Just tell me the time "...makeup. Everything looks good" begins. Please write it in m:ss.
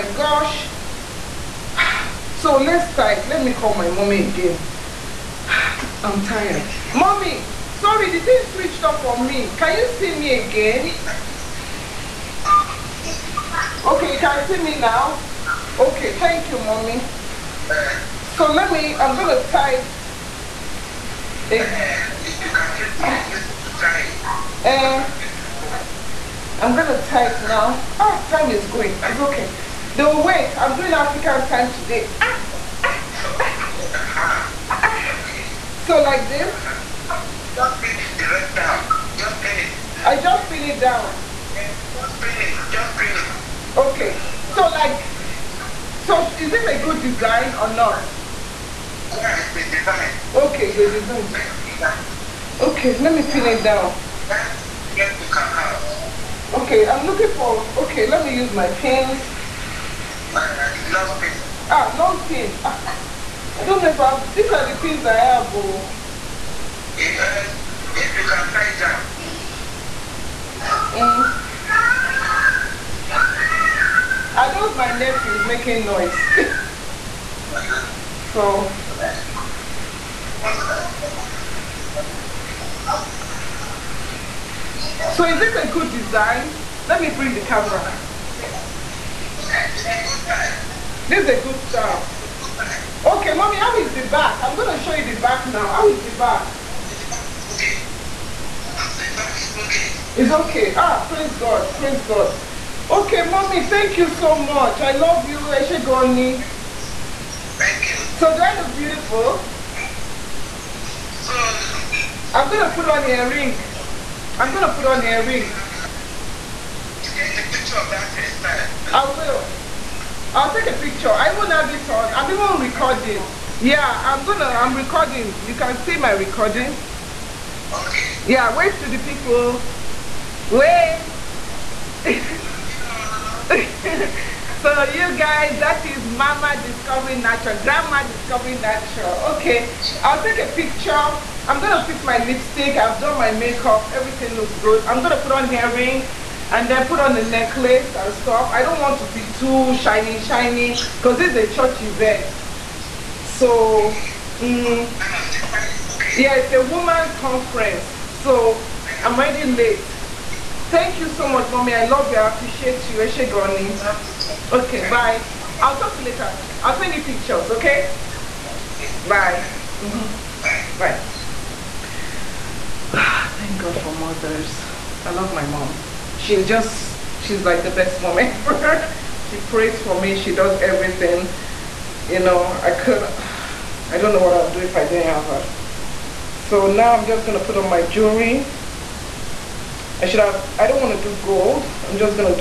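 2:23.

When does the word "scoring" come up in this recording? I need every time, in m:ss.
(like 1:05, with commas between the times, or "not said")
not said.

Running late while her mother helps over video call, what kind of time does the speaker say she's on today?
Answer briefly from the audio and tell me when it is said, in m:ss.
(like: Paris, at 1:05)
African time, at 0:30.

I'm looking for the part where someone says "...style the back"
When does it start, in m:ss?
1:31.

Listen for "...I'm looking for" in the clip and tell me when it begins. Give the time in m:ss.
0:56.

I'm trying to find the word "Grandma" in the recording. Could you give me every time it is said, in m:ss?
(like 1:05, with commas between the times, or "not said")
2:17.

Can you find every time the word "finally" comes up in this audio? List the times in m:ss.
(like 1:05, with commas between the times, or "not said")
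not said.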